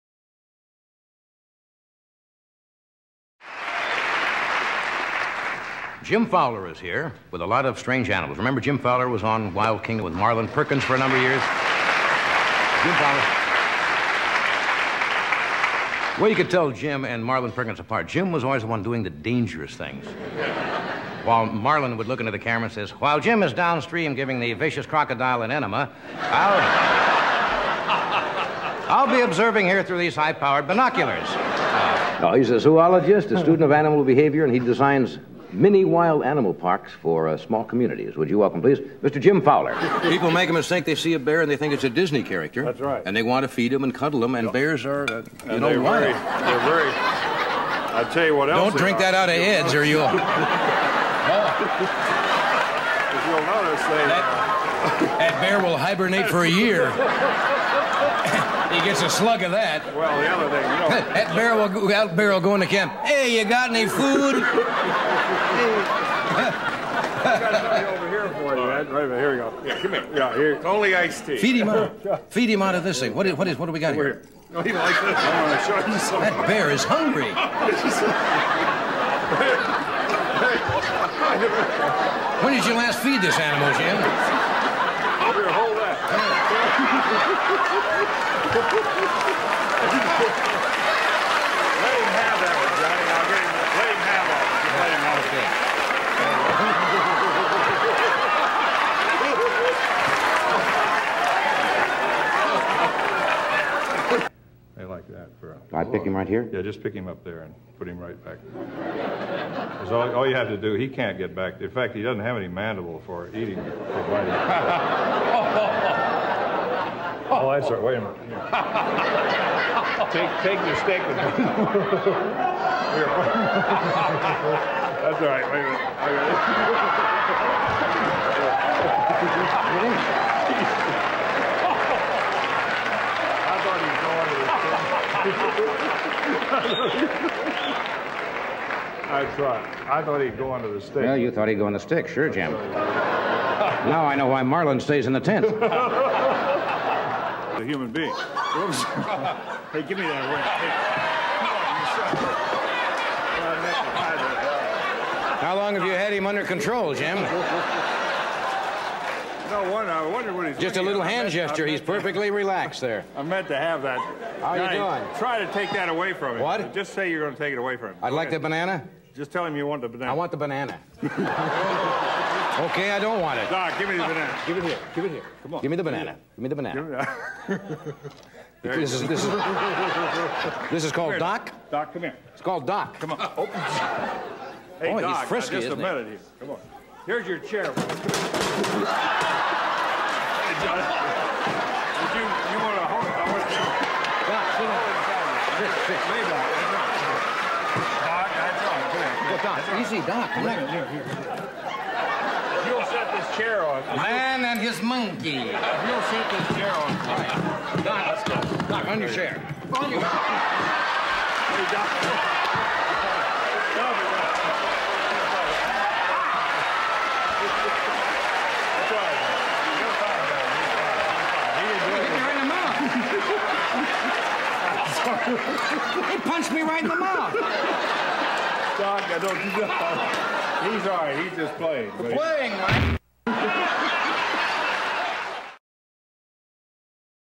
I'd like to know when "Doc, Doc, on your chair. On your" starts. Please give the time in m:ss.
3:27.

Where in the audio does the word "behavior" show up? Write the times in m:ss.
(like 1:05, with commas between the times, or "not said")
0:34.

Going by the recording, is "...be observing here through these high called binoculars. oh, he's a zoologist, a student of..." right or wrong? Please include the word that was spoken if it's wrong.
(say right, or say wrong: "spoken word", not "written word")
wrong: "powered", not "called".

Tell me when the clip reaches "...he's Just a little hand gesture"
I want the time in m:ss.
2:40.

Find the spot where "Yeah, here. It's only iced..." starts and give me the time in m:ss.
1:10.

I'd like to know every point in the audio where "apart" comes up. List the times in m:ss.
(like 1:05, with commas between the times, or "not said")
0:17.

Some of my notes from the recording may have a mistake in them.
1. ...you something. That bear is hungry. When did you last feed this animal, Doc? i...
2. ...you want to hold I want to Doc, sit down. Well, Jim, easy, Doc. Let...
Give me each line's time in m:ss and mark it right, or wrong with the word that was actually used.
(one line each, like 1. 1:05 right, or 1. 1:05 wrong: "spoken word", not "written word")
1. 1:15 wrong: "Jim", not "Doc"
2. 3:12 wrong: "Doc", not "Jim".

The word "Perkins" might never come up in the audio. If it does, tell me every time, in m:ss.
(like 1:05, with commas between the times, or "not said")
0:10, 0:17.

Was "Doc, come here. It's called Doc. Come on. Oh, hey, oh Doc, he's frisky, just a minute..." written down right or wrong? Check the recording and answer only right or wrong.
right.